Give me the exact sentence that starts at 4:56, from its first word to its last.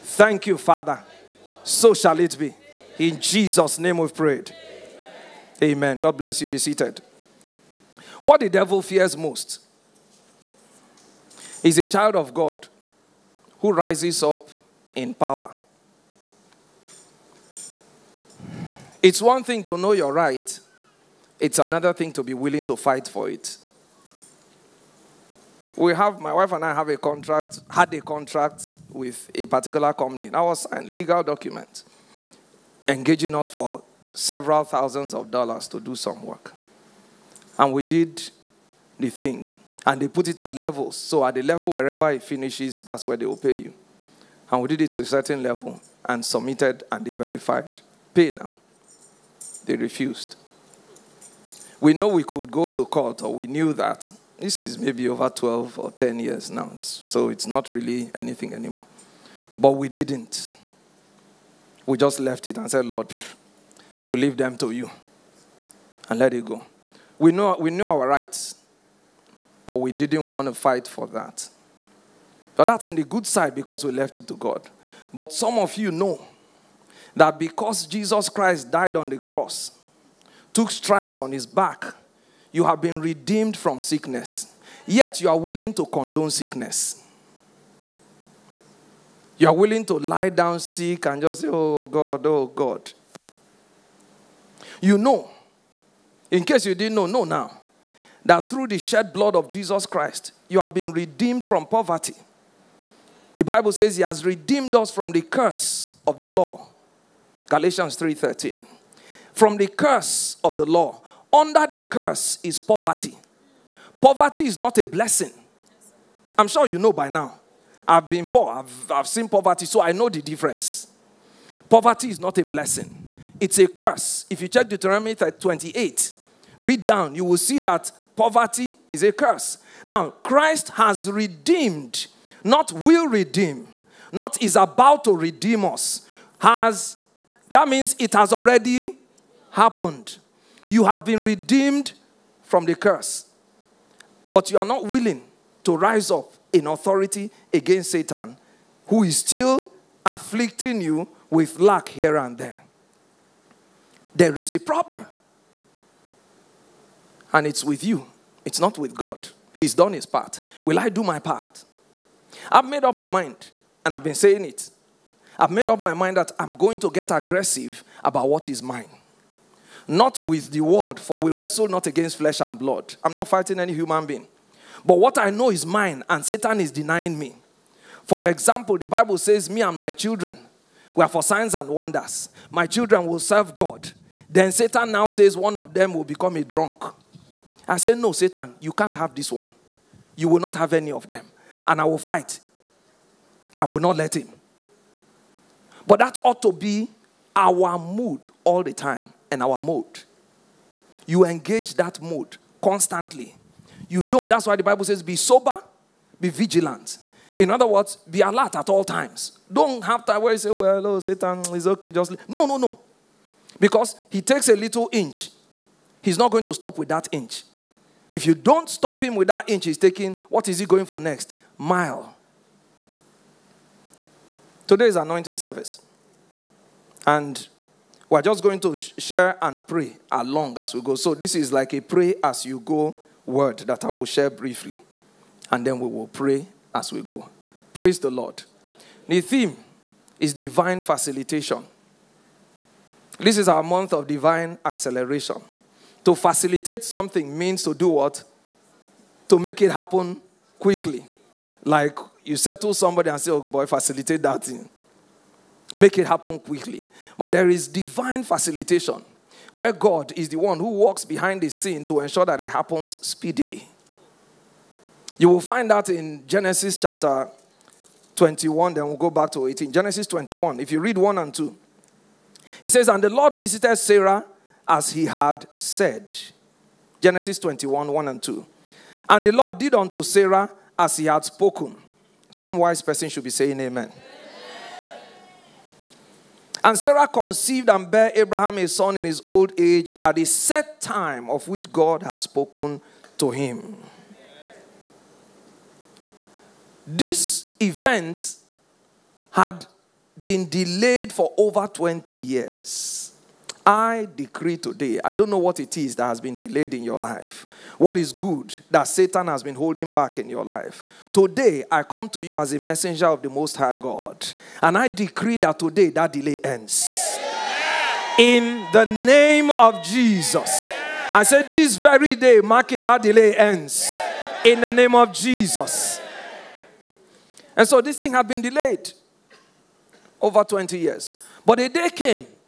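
This event had been delayed for over 20 years.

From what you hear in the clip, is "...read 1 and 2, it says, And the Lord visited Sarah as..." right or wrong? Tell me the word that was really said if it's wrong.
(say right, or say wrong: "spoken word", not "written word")
right.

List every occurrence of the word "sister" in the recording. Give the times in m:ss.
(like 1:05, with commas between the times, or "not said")
not said.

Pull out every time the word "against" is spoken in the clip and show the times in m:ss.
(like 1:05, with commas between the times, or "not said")
2:27, 2:51.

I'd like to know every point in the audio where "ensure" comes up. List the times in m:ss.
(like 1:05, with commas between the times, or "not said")
4:22.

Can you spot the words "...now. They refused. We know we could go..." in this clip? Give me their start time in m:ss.
0:48.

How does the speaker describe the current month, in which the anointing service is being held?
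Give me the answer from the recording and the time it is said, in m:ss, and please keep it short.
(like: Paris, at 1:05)
Month of divine acceleration, at 4:03.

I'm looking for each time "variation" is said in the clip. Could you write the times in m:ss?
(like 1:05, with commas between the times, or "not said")
not said.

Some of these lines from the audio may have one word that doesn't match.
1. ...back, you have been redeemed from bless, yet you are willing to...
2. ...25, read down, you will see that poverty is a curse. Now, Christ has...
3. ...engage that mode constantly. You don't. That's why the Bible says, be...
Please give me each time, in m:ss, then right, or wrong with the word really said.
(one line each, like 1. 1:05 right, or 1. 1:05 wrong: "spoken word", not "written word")
1. 1:21 wrong: "sickness", not "bless"
2. 2:05 wrong: "28", not "25"
3. 3:21 right.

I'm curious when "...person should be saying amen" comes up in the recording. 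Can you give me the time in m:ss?
4:42.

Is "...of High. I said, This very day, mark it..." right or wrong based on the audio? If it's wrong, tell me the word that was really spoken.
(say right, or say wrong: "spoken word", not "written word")
wrong: "Jesus", not "High".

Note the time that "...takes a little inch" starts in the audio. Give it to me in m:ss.
3:34.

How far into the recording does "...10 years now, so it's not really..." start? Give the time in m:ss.
0:55.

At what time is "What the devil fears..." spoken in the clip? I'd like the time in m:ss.
0:08.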